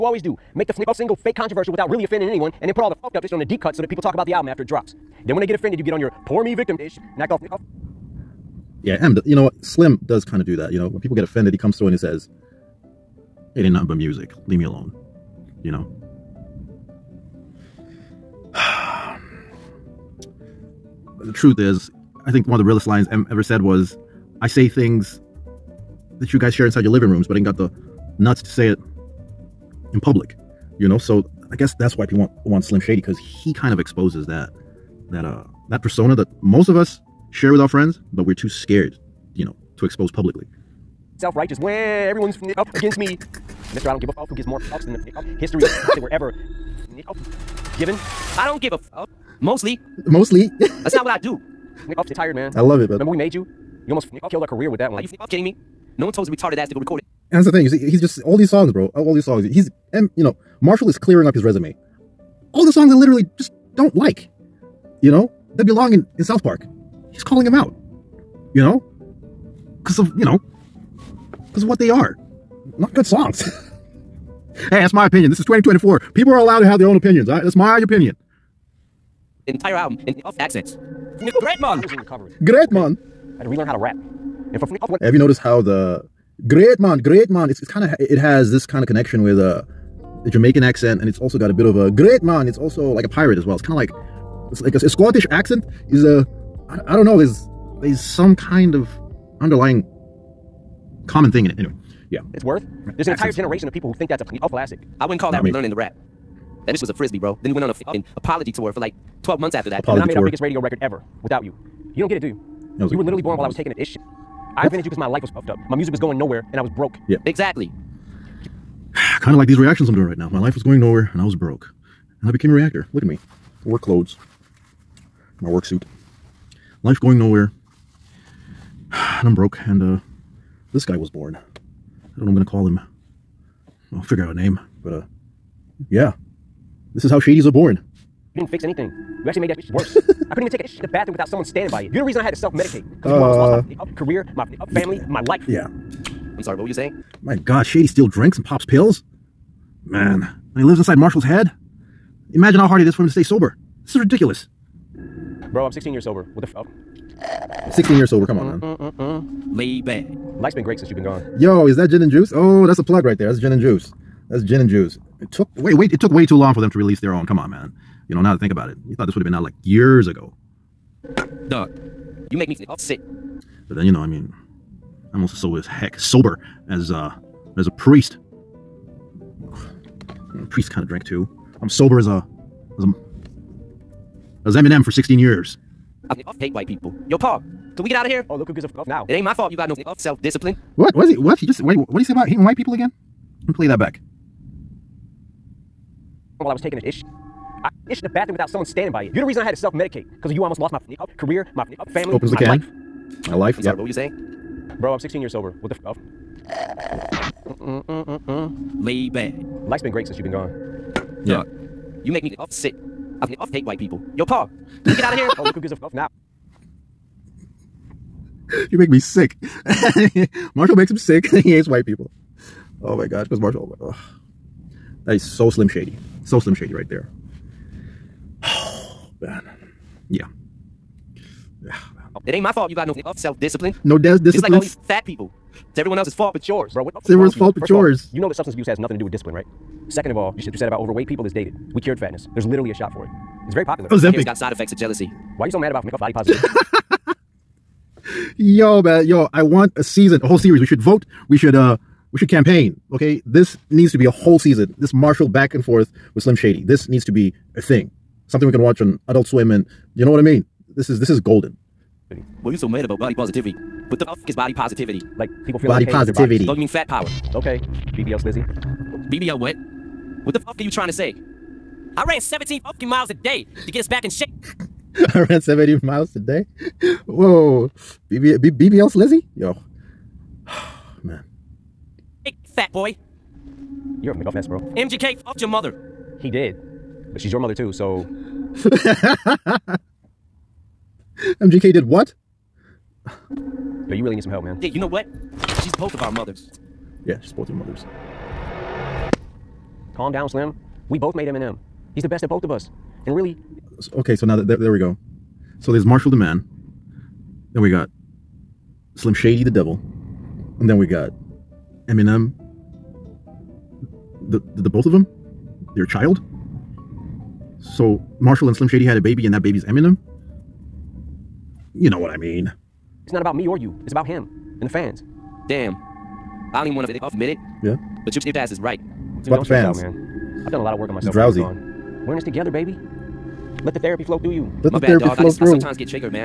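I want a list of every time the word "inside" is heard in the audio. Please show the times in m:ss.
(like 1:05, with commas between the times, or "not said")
0:26, 2:30.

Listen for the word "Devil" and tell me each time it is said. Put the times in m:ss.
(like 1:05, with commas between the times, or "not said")
5:09.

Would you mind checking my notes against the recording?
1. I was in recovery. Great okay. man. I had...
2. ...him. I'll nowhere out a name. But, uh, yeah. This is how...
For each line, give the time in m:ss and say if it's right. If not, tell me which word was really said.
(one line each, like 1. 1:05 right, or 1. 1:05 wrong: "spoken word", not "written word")
1. 1:21 right
2. 2:12 wrong: "figure", not "nowhere".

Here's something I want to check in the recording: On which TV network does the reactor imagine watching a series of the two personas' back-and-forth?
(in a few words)
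Adult Swim.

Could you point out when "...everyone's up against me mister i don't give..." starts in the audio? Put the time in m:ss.
0:42.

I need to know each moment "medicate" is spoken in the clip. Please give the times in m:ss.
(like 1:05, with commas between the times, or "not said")
2:22, 3:19.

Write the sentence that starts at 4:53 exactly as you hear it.
Yo, you really need some help, man.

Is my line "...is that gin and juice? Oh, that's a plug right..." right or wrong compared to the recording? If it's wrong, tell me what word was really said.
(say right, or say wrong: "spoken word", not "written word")
right.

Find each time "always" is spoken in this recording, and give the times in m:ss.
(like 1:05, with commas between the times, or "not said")
0:00.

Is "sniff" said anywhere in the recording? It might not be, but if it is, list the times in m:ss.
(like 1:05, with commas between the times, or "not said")
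5:28.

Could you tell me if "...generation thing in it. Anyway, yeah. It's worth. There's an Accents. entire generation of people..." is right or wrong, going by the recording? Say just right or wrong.
wrong.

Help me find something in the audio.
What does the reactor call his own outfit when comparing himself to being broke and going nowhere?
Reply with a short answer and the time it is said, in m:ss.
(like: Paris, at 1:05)
work suit, at 2:05.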